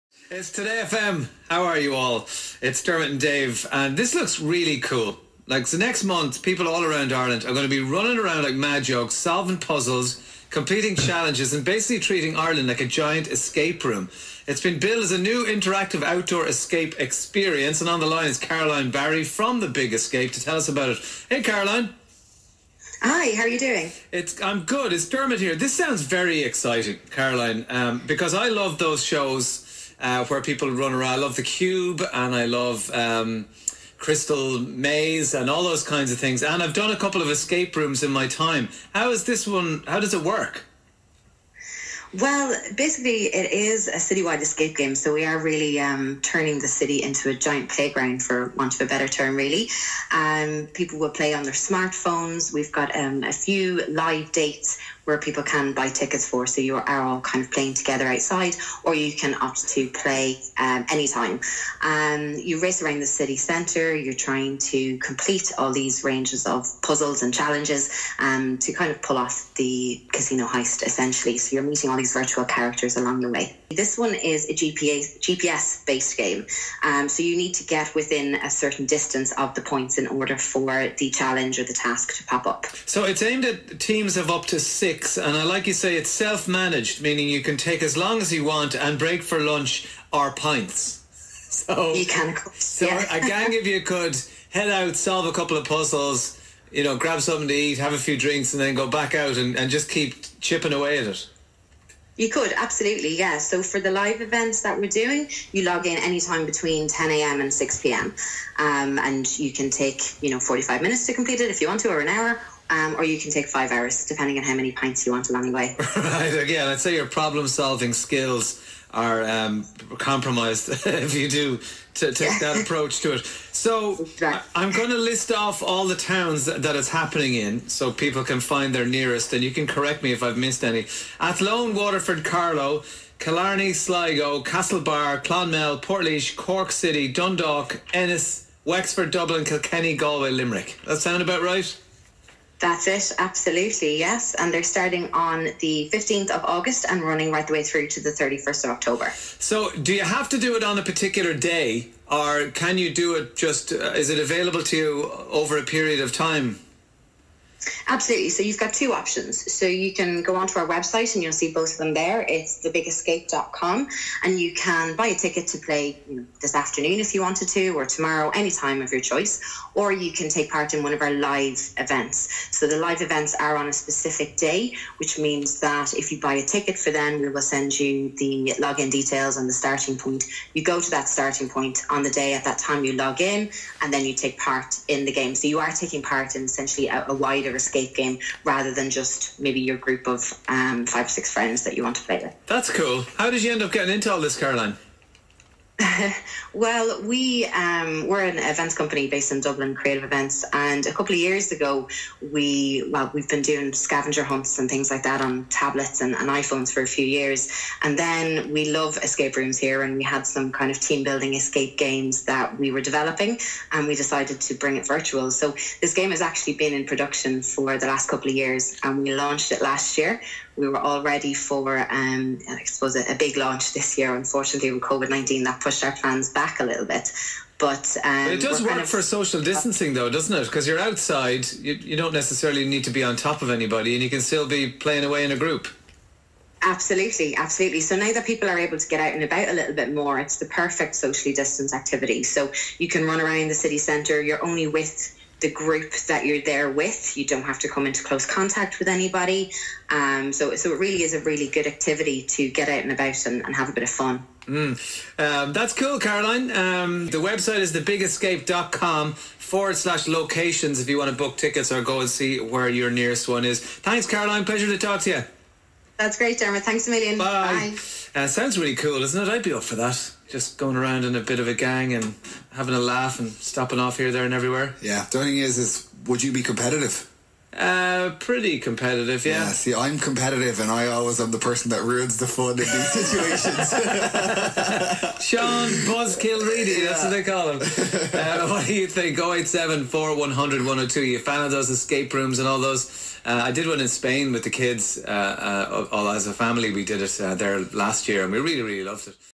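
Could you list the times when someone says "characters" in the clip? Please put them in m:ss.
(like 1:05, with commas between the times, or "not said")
1:12.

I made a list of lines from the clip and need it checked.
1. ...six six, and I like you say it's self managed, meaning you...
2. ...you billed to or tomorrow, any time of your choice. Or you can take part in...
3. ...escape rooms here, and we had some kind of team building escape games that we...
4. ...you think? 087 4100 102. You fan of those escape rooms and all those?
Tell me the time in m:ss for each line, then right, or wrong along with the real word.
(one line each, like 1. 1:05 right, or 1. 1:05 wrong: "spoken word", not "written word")
1. 1:24 right
2. 2:47 wrong: "wanted", not "billed"
3. 3:28 right
4. 4:48 right.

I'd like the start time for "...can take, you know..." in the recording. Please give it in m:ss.
1:49.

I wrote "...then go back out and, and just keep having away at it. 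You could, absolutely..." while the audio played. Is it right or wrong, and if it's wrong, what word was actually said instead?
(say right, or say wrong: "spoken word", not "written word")
wrong: "chipping", not "having".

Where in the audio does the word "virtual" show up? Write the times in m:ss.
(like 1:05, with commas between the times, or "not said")
1:12, 3:34.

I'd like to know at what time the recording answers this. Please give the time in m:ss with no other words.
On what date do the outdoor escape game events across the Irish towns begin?
2:25.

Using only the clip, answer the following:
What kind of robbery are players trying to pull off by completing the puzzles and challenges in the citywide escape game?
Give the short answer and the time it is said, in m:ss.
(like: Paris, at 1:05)
Casino heist, at 1:10.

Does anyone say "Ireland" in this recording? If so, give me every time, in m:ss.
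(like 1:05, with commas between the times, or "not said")
0:07, 0:12.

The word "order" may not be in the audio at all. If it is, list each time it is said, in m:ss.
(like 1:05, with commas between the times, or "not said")
1:20.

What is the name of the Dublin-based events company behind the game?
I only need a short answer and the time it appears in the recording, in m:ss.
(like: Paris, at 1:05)
Creative Events, at 3:19.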